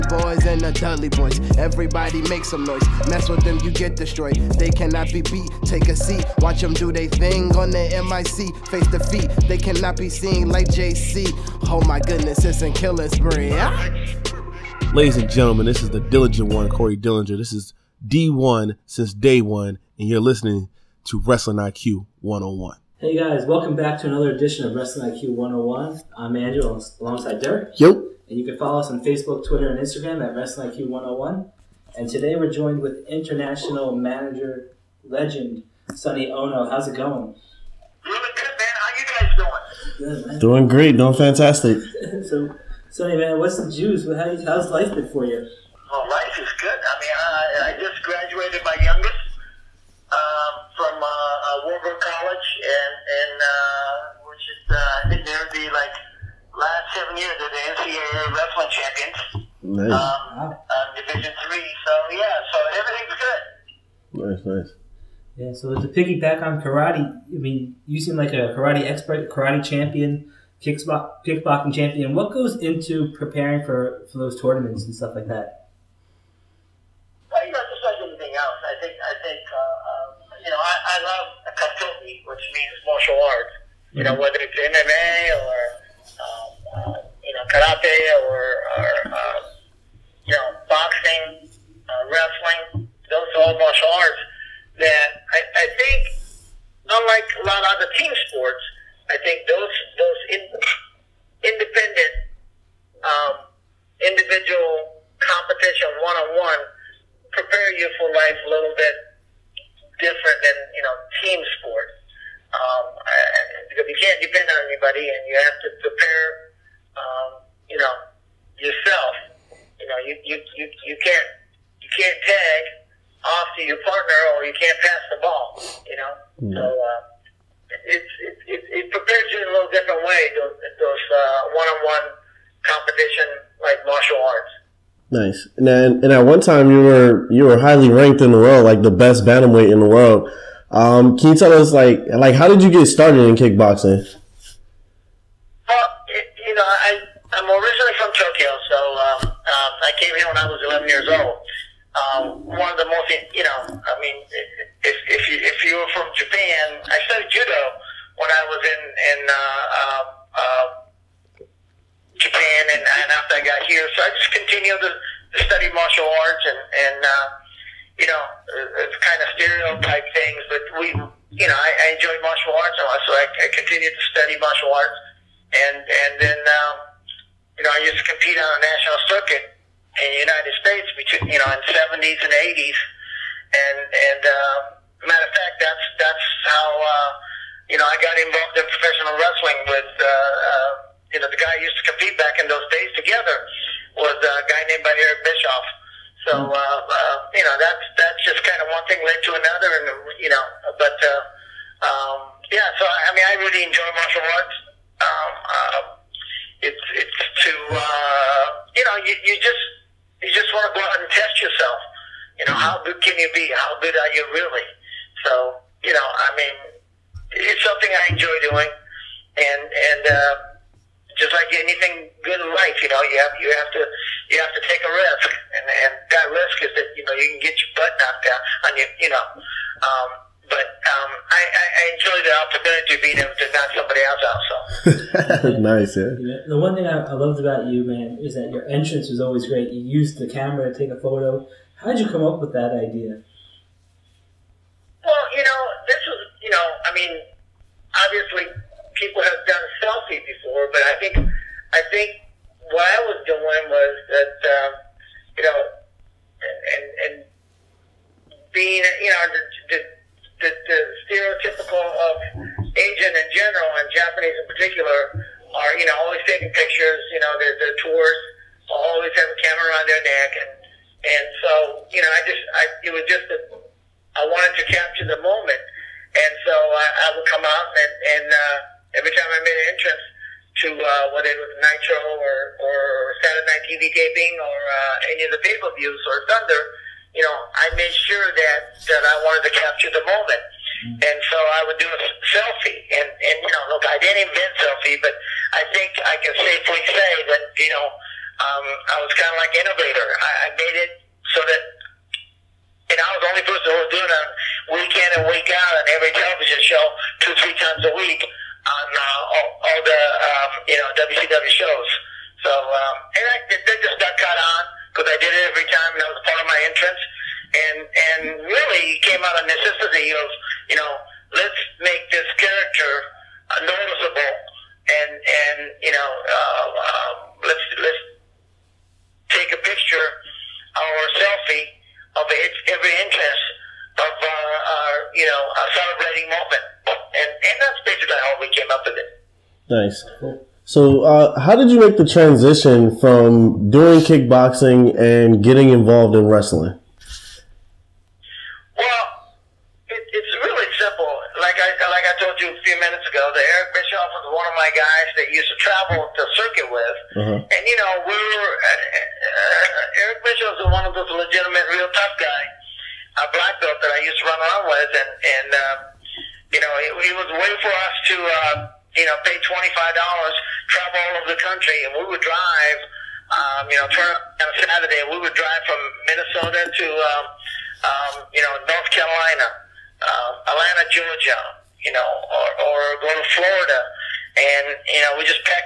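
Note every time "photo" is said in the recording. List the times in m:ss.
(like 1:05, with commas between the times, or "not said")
4:01.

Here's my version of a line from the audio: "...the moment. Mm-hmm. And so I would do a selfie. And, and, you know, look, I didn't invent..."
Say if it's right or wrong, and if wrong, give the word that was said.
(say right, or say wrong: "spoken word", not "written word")
right.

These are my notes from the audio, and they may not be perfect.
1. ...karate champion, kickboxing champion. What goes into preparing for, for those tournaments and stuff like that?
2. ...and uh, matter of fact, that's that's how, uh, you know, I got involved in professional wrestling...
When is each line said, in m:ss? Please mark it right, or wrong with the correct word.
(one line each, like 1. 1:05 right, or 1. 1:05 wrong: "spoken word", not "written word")
1. 1:09 right
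2. 3:03 right.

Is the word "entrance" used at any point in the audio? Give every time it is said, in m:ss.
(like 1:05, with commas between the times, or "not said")
3:58, 4:39, 5:16, 5:33.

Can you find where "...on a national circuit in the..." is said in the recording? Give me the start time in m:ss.
2:58.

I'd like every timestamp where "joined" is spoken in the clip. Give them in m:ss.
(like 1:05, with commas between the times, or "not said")
0:32.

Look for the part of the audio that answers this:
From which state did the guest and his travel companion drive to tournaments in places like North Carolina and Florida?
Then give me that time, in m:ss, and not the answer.
6:16.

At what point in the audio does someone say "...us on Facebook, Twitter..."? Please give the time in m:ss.
0:28.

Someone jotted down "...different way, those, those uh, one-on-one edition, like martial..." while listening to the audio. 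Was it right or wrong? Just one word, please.
wrong.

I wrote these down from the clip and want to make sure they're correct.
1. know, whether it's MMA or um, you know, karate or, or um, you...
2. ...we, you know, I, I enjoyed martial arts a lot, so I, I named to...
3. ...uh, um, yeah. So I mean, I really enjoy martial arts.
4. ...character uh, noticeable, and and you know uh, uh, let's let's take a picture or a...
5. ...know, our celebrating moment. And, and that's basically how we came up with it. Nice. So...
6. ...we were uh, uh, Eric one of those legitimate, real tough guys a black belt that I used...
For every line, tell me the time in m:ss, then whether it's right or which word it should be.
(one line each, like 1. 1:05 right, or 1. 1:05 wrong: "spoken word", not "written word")
1. 1:24 right
2. 2:50 wrong: "continued", not "named"
3. 3:20 right
4. 5:22 right
5. 5:35 right
6. 5:58 right.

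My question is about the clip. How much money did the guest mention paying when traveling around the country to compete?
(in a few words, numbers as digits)
$25.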